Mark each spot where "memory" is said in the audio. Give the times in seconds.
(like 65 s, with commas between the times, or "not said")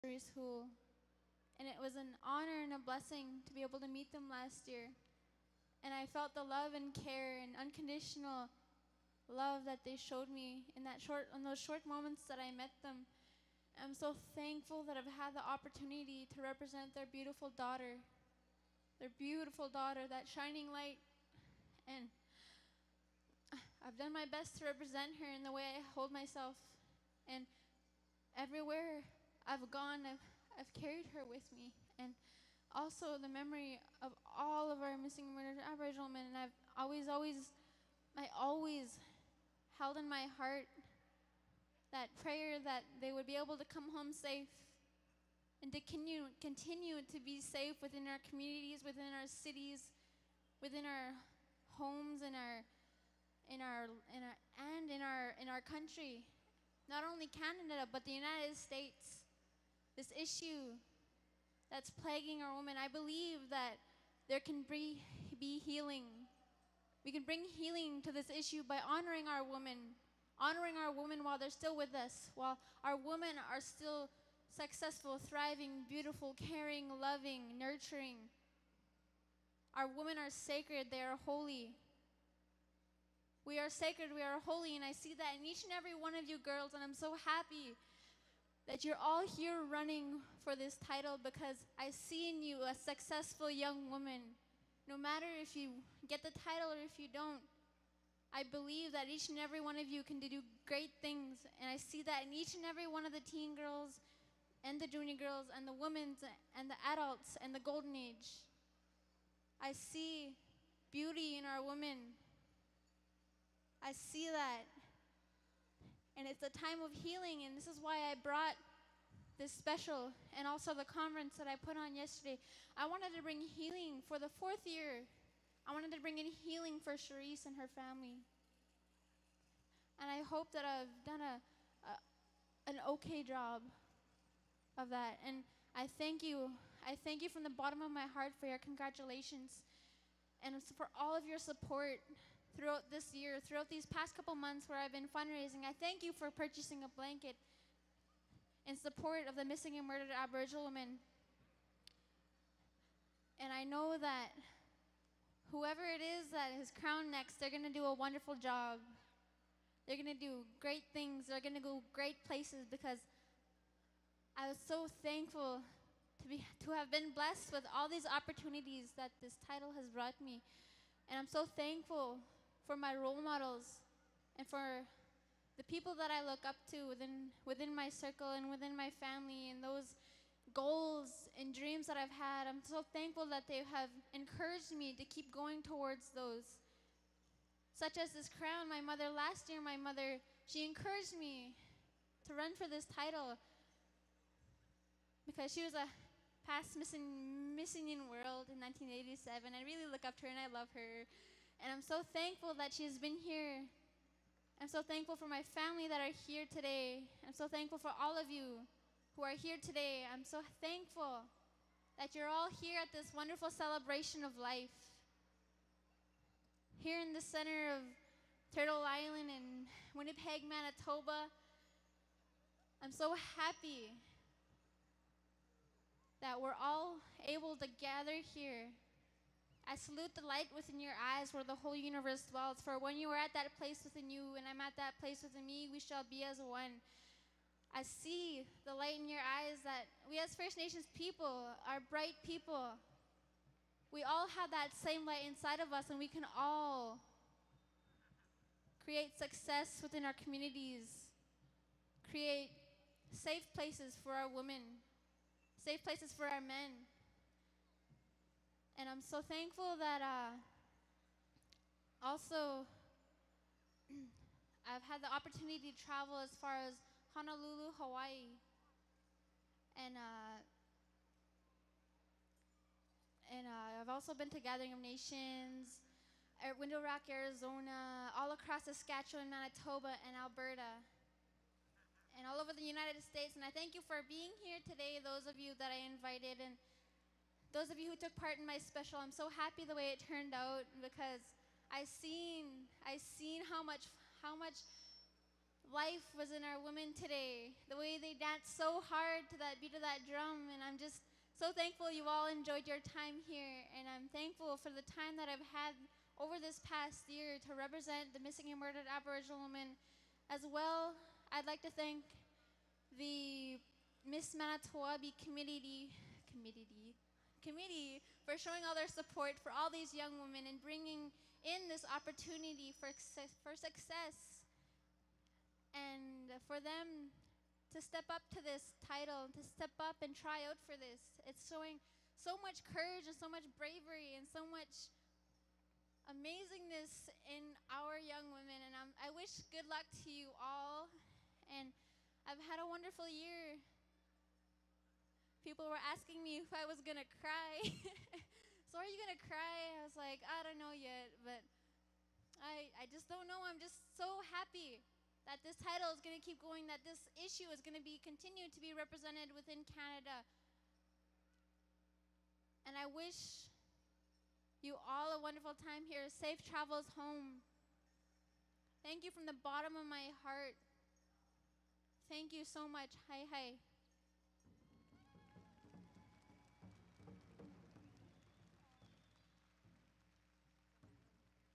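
33 s.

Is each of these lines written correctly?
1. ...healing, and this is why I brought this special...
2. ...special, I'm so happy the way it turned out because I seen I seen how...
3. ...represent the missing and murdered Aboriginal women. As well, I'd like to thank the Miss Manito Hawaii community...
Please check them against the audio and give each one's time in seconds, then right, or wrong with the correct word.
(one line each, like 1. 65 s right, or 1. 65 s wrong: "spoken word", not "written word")
1. 116 s right
2. 288 s right
3. 307 s wrong: "Ahbee", not "Hawaii".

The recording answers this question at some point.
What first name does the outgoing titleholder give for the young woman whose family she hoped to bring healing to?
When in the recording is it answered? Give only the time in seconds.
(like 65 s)
126 s.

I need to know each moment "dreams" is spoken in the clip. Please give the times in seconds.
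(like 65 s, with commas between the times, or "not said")
181 s.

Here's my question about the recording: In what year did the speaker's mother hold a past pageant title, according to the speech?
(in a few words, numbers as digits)
1987.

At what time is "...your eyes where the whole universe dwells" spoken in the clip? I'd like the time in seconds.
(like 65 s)
230 s.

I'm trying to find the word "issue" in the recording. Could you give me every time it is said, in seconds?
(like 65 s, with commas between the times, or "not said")
60 s, 68 s, 357 s.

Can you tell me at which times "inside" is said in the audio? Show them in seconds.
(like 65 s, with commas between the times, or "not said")
245 s.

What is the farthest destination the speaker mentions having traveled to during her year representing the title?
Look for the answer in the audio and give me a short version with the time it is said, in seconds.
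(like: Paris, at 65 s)
Honolulu, Hawaii, at 267 s.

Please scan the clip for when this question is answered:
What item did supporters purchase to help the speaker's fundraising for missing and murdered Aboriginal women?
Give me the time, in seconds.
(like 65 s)
146 s.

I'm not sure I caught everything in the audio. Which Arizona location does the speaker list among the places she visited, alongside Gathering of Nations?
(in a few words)
Window Rock.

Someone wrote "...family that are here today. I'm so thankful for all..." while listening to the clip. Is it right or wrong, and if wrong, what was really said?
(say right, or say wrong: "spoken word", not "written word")
right.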